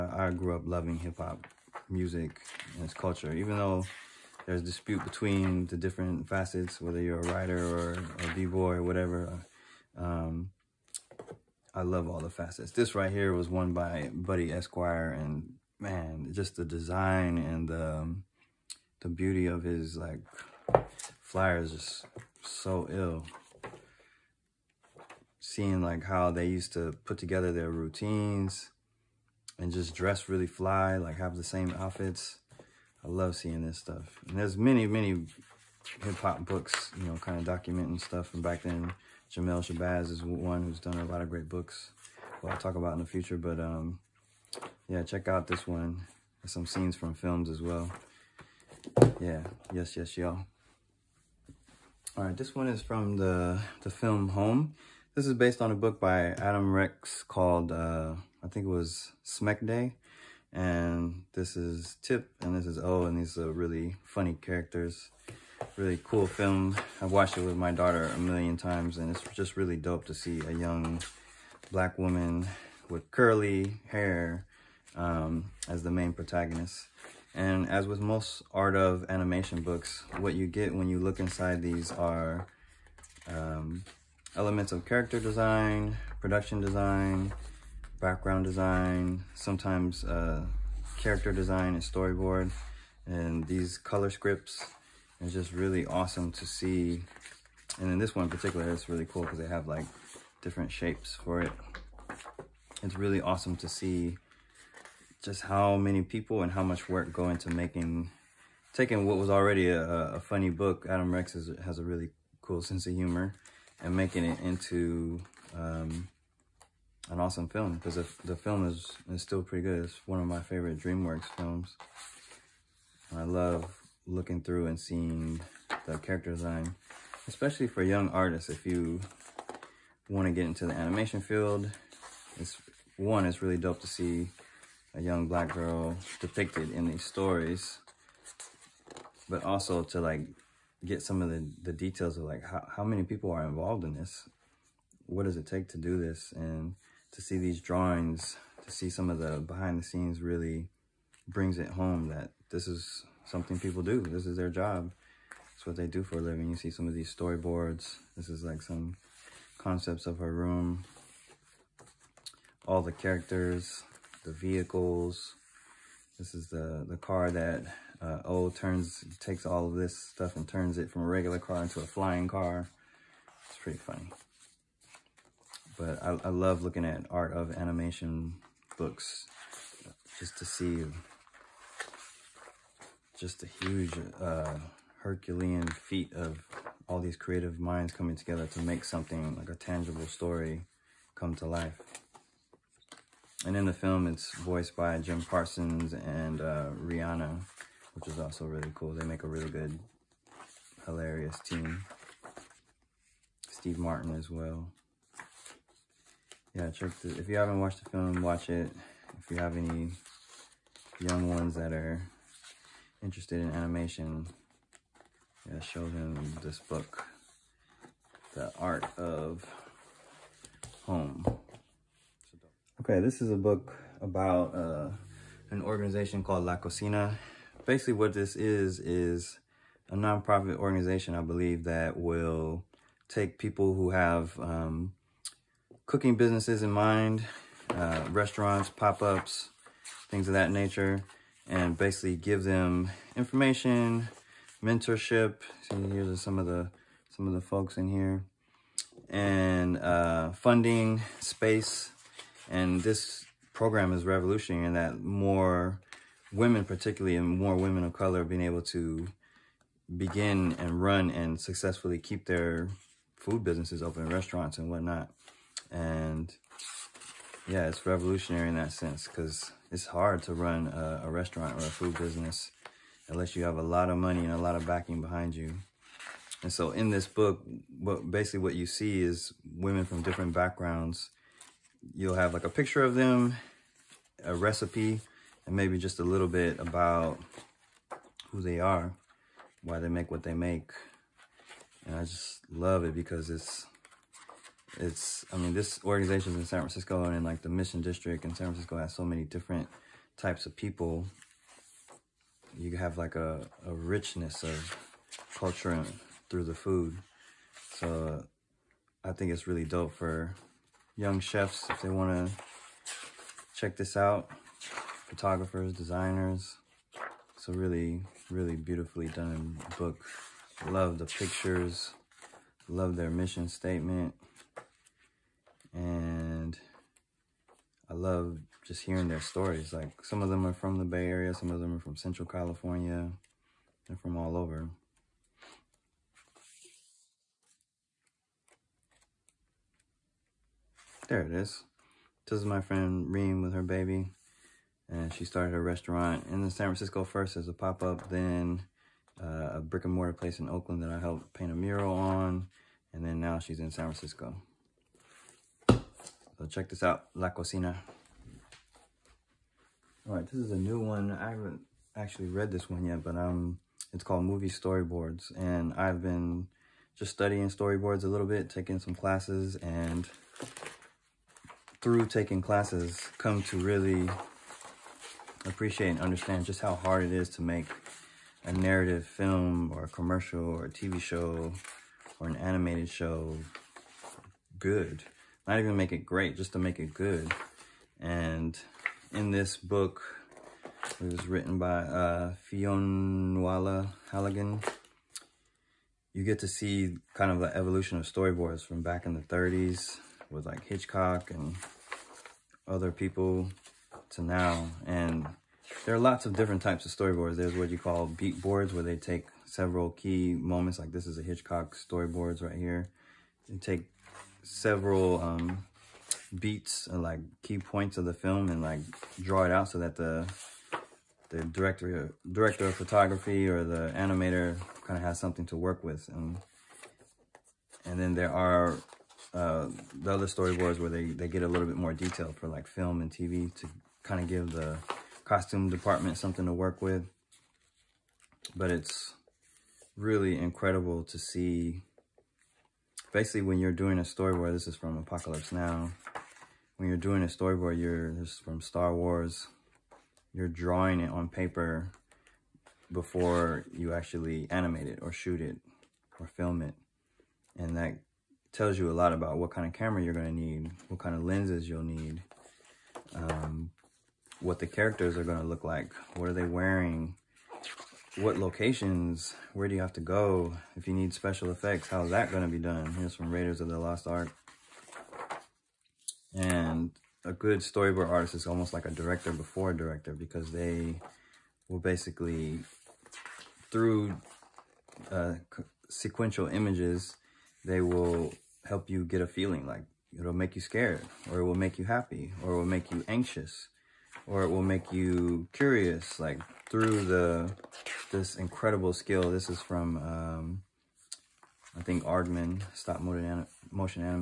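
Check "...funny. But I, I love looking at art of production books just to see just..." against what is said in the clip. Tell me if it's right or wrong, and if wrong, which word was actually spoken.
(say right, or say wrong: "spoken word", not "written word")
wrong: "animation", not "production".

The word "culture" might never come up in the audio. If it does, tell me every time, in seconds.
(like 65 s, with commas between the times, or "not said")
2 s, 305 s.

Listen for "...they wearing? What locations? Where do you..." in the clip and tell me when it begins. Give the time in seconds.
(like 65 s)
466 s.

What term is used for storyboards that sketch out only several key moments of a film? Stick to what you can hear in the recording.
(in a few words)
beat boards.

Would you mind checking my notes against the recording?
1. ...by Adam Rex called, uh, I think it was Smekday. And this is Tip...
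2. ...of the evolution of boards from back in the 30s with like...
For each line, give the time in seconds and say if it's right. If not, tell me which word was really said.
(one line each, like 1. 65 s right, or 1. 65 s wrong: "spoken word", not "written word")
1. 56 s right
2. 397 s wrong: "storyboards", not "boards".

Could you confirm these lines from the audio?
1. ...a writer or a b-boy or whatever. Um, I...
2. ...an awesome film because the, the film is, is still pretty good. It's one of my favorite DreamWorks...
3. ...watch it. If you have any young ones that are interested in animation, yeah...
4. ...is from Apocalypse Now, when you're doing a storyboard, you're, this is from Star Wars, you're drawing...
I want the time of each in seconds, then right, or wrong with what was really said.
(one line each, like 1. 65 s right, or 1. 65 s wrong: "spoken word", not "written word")
1. 7 s right
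2. 117 s right
3. 208 s right
4. 444 s right.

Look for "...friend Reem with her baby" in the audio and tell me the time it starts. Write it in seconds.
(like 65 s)
342 s.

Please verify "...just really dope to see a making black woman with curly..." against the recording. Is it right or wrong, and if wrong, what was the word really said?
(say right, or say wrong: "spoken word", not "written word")
wrong: "young", not "making".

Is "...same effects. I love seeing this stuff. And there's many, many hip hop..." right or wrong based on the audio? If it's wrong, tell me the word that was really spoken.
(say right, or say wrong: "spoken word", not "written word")
wrong: "outfits", not "effects".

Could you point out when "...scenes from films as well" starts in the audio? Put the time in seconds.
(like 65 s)
46 s.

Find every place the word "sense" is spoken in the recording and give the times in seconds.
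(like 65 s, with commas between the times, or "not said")
112 s, 268 s.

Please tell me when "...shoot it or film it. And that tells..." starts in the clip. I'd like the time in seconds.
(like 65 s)
455 s.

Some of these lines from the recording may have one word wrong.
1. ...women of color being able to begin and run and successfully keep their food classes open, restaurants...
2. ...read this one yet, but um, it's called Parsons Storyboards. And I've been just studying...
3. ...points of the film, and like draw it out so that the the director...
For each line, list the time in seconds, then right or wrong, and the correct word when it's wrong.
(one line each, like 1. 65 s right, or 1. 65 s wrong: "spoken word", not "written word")
1. 257 s wrong: "businesses", not "classes"
2. 362 s wrong: "Movie", not "Parsons"
3. 417 s right.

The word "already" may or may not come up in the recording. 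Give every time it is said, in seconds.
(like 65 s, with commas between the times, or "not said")
109 s.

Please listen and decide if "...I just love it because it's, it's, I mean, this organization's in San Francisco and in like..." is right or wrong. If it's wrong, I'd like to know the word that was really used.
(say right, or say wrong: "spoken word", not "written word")
right.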